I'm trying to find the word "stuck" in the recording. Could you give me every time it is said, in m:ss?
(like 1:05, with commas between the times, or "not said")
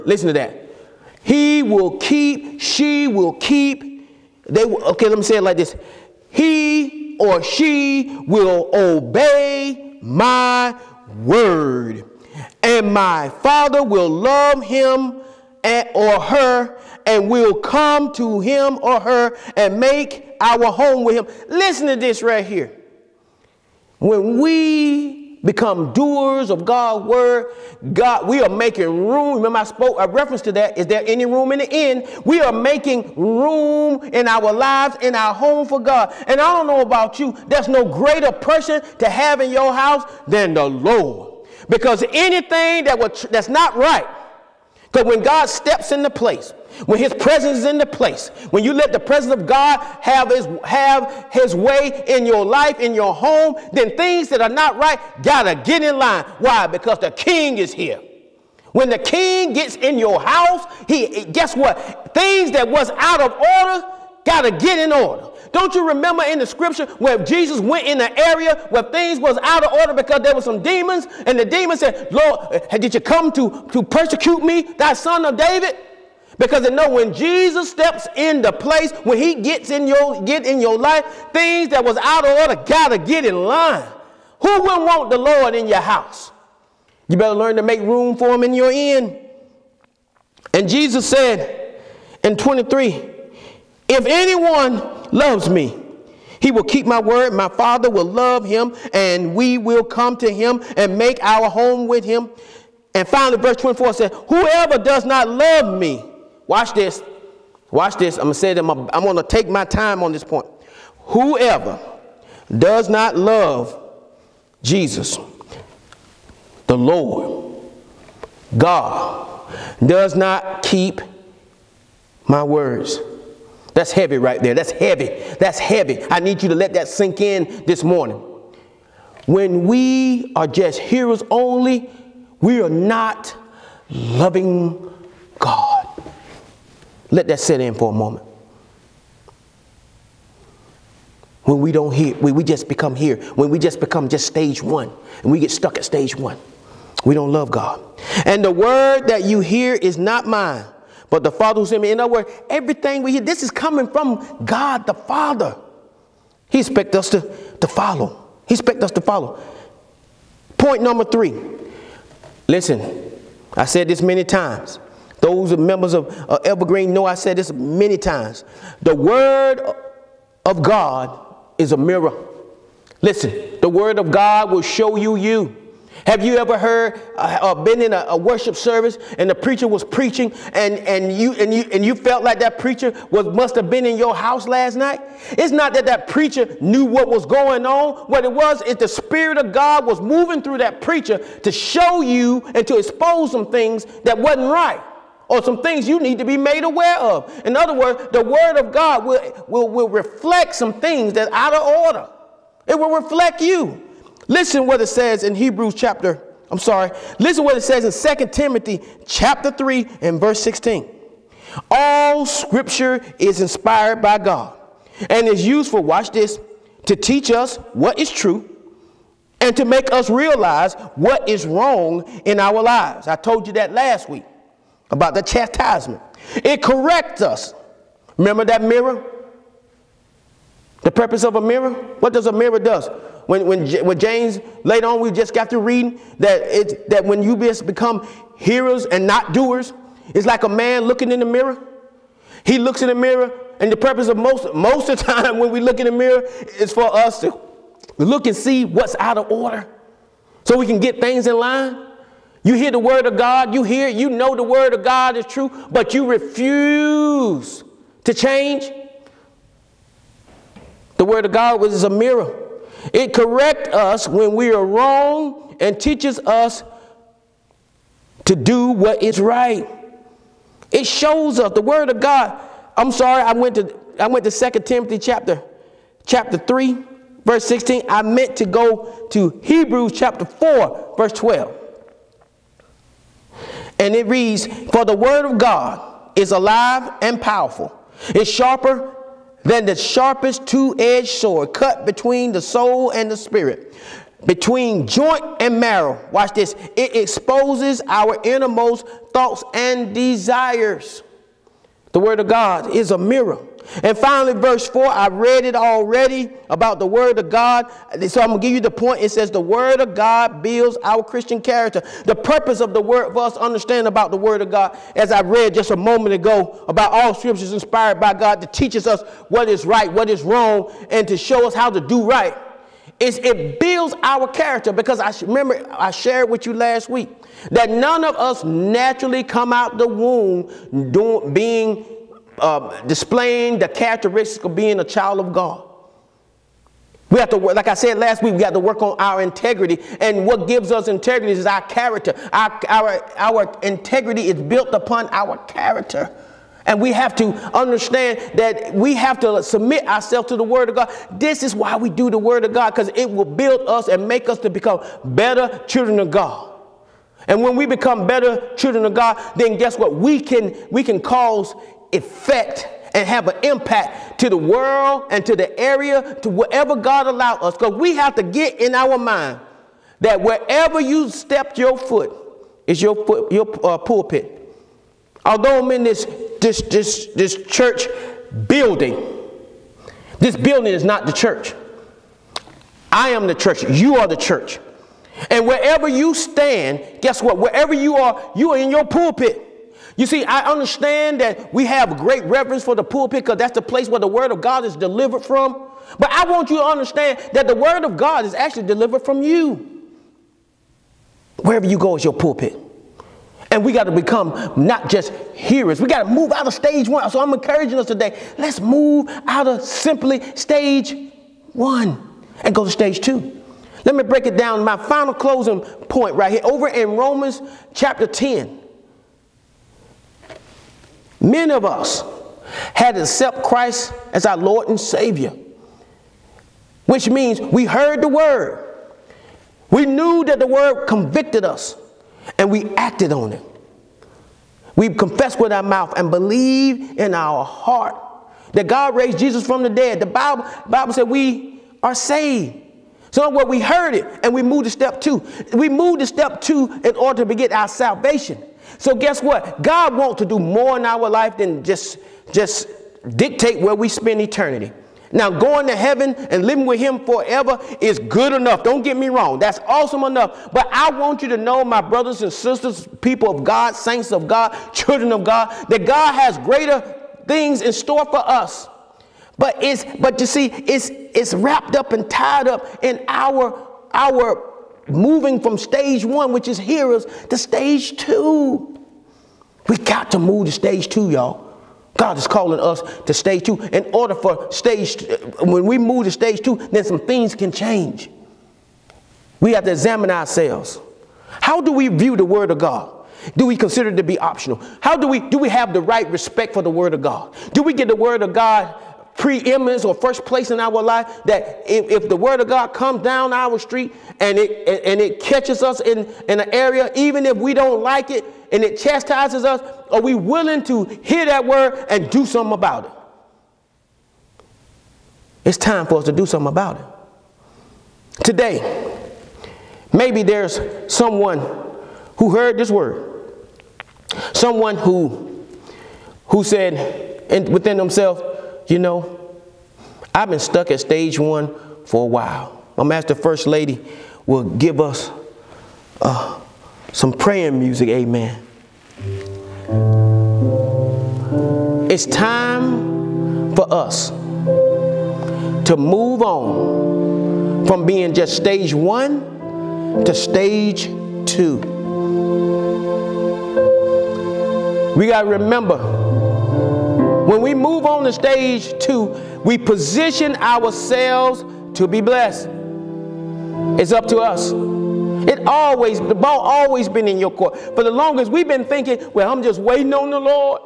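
2:25, 8:50.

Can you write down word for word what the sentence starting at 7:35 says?
Now, going to heaven and living with him forever is good enough.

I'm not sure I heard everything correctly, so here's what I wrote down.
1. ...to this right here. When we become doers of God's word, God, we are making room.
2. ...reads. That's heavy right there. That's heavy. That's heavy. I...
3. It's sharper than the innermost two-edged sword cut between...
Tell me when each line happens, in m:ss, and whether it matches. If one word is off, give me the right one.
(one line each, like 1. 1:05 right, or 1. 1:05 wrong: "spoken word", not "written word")
1. 0:21 right
2. 2:02 wrong: "words", not "reads"
3. 4:48 wrong: "sharpest", not "innermost".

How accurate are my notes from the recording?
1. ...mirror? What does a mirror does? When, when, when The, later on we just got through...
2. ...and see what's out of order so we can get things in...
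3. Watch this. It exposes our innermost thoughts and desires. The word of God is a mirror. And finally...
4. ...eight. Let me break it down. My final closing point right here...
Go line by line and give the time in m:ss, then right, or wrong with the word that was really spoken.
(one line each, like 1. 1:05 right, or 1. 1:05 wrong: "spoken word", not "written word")
1. 3:51 wrong: "James", not "The"
2. 4:08 right
3. 4:56 right
4. 6:52 wrong: "two", not "eight".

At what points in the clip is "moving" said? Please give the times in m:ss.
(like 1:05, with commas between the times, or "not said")
3:09, 7:54.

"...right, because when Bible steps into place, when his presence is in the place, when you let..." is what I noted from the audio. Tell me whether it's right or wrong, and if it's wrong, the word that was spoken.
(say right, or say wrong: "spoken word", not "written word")
wrong: "God", not "Bible".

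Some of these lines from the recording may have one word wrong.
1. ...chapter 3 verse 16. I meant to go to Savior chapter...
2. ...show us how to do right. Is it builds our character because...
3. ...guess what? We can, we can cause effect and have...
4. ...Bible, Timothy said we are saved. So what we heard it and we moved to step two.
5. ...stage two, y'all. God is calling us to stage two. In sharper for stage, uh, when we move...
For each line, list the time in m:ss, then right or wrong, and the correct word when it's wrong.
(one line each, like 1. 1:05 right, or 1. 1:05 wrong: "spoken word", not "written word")
1. 4:36 wrong: "Hebrews", not "Savior"
2. 5:21 right
3. 5:59 right
4. 7:20 wrong: "Bible", not "Timothy"
5. 8:00 wrong: "order", not "sharper".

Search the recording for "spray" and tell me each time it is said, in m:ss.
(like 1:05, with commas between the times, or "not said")
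not said.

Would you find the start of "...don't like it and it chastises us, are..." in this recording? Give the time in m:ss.
8:27.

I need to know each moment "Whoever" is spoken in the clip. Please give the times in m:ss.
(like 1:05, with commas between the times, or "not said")
1:44, 1:50.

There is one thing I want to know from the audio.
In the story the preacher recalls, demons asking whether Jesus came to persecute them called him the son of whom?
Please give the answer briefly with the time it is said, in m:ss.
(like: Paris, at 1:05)
David, at 1:15.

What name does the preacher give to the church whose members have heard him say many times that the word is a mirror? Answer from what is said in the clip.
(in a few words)
Evergreen.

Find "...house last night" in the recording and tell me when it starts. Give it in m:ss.
3:04.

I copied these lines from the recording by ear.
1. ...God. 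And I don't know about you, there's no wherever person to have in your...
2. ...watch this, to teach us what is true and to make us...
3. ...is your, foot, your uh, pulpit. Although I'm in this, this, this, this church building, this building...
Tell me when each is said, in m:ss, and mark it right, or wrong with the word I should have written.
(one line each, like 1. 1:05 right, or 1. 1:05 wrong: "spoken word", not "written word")
1. 0:35 wrong: "greater", not "wherever"
2. 3:35 right
3. 6:12 right.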